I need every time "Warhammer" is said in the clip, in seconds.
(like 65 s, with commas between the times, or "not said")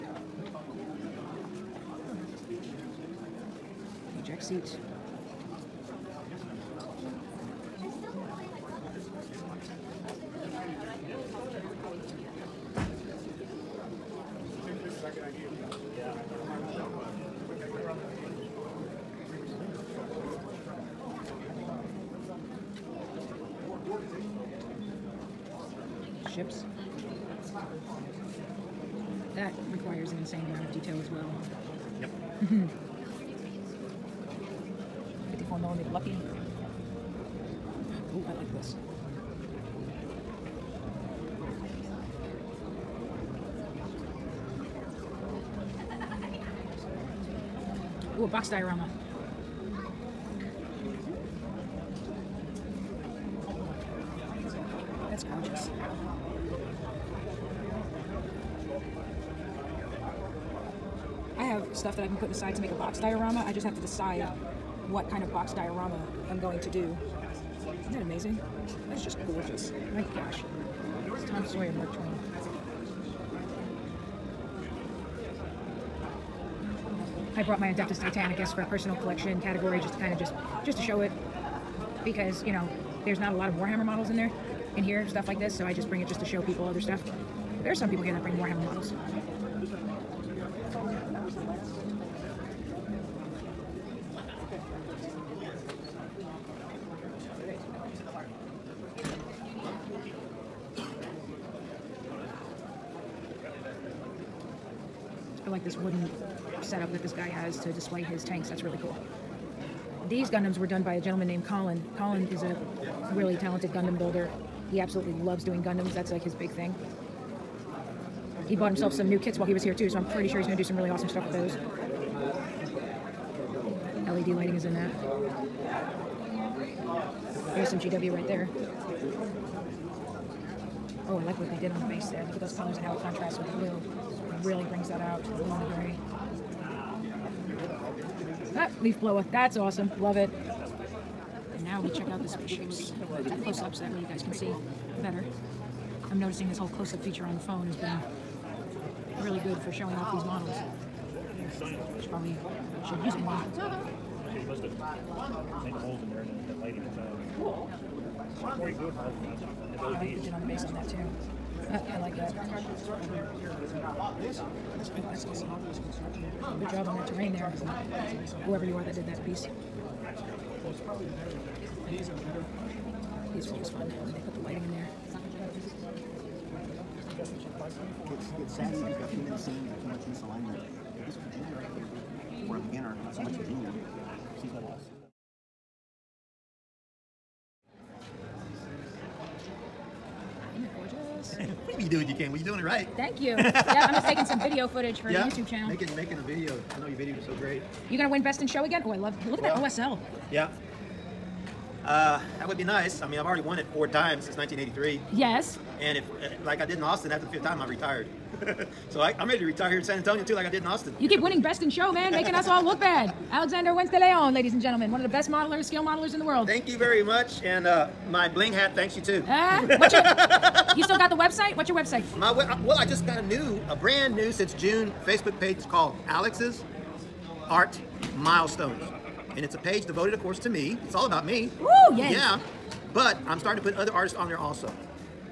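83 s, 88 s.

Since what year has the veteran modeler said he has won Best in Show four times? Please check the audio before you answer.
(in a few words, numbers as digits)
1983.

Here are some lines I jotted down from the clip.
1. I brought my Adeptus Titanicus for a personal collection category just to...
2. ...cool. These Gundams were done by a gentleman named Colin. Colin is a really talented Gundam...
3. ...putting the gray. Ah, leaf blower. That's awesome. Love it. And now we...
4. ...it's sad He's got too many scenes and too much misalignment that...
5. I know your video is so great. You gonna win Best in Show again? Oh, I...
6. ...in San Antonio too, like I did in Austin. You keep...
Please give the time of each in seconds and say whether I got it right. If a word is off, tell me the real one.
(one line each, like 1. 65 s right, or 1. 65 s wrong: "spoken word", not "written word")
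1. 77 s right
2. 108 s right
3. 135 s wrong: "along", not "putting"
4. 178 s right
5. 196 s right
6. 209 s right.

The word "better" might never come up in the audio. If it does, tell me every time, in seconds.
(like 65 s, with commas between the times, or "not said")
145 s.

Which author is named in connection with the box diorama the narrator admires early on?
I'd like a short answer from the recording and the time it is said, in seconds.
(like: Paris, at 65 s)
Mark Twain, at 71 s.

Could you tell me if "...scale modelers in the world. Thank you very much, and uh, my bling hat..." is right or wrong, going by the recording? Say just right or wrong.
right.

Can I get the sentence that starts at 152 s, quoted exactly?
She probably should use it more.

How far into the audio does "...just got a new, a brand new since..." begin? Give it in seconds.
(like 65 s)
222 s.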